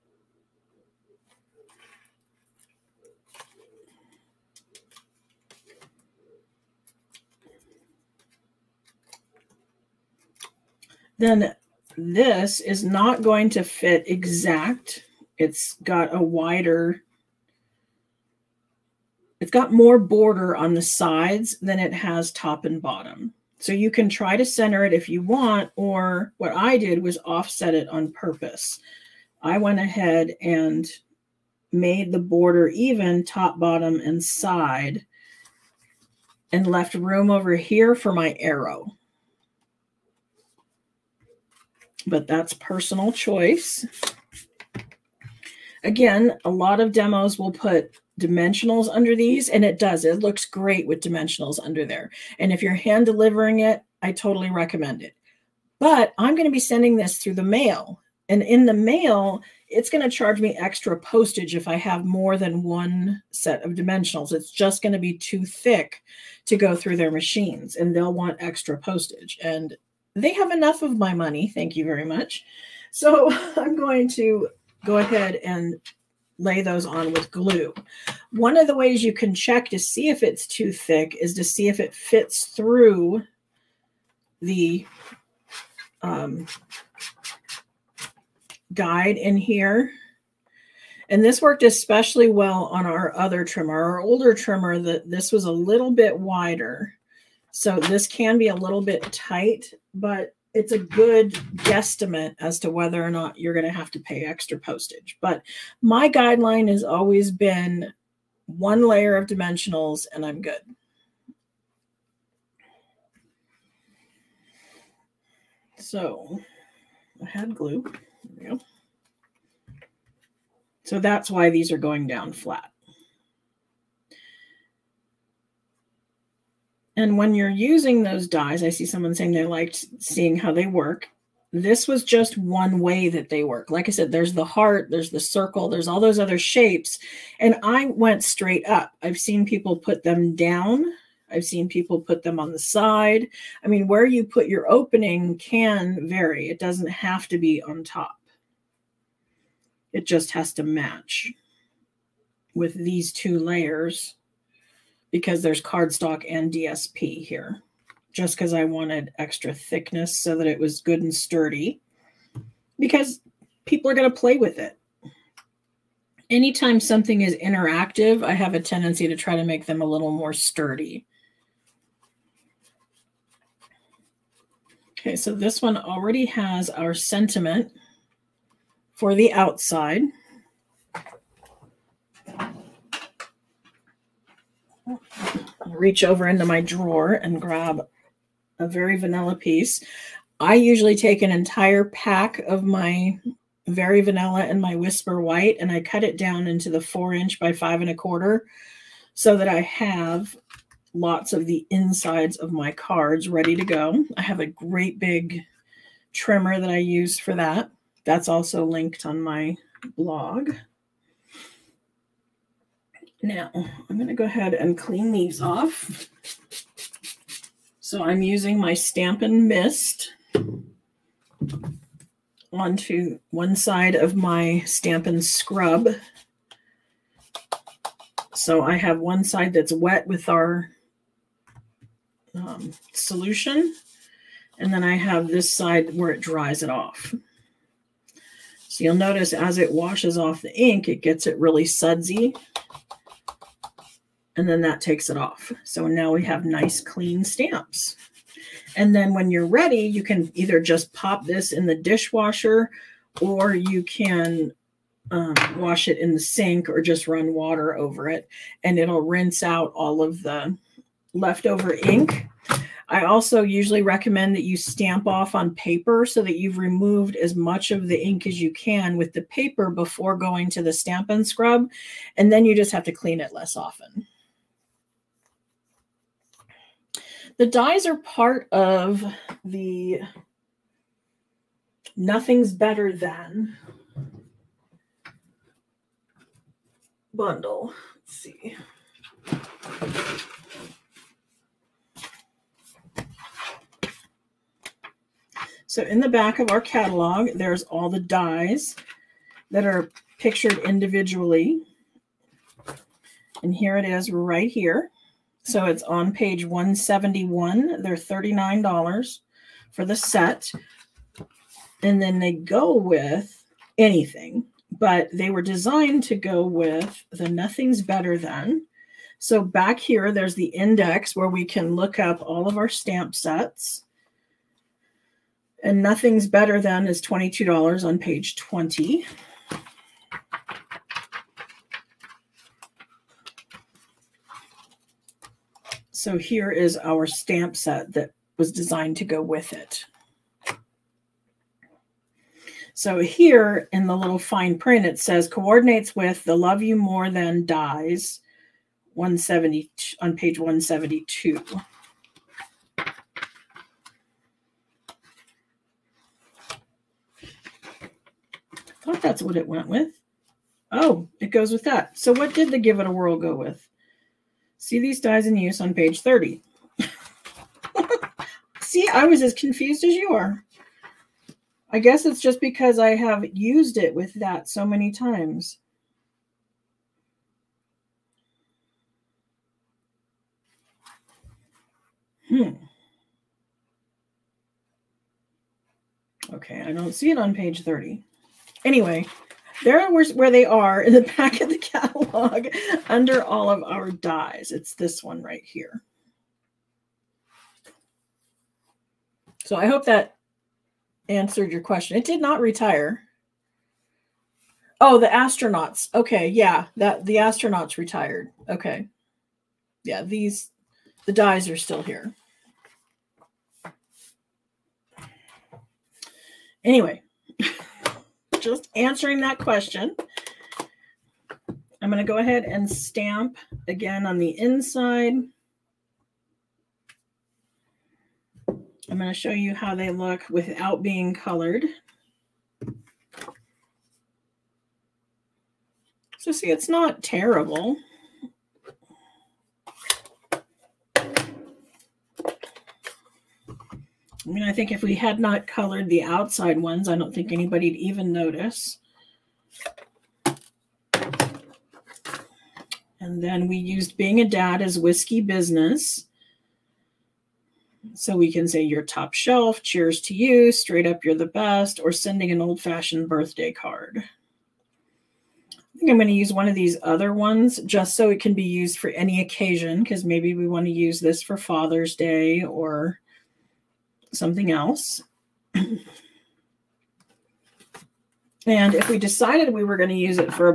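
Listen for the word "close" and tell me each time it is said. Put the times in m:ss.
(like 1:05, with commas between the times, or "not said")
not said.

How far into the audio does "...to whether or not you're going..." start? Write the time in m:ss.
1:42.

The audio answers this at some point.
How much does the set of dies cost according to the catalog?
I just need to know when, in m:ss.
5:07.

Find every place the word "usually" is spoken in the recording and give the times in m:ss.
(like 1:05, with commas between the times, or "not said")
3:10, 4:23.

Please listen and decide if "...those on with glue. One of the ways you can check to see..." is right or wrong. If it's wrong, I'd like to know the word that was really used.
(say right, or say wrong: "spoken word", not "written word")
right.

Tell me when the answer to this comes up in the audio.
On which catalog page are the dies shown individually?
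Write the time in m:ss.
5:06.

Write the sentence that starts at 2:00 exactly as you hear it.
So that's why these are going down flat.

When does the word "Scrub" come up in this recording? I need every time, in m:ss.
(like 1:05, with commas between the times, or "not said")
3:45, 4:31.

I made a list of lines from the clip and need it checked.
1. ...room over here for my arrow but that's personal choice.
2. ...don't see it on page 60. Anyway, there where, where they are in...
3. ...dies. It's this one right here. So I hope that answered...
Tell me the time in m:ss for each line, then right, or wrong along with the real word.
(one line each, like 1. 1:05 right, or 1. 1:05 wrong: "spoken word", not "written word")
1. 0:36 right
2. 6:26 wrong: "30", not "60"
3. 6:33 right.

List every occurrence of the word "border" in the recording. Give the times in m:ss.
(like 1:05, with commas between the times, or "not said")
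0:19, 0:32.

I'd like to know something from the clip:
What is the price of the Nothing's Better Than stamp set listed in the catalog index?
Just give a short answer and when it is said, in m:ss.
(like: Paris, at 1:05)
$22, at 5:27.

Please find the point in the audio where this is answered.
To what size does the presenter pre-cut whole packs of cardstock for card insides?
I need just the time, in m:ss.
3:16.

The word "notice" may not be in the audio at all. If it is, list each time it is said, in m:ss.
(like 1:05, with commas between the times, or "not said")
3:58, 7:28.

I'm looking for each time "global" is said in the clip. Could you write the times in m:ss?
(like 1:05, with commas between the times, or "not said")
not said.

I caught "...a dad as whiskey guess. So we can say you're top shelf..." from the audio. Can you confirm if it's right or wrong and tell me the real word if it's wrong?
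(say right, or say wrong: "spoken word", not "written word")
wrong: "business", not "guess".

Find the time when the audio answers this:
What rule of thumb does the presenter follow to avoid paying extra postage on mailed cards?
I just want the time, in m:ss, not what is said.
1:48.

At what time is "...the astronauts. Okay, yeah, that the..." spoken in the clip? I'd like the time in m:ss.
6:44.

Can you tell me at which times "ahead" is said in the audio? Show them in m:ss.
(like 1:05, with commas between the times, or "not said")
0:29, 1:14, 3:34, 7:02.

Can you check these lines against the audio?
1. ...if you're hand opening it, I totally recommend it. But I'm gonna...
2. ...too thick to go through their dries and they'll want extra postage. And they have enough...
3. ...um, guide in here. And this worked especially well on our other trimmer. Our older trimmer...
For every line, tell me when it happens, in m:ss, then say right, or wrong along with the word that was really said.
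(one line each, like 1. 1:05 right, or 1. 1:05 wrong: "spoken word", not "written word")
1. 0:52 wrong: "delivering", not "opening"
2. 1:05 wrong: "machines", not "dries"
3. 1:26 right.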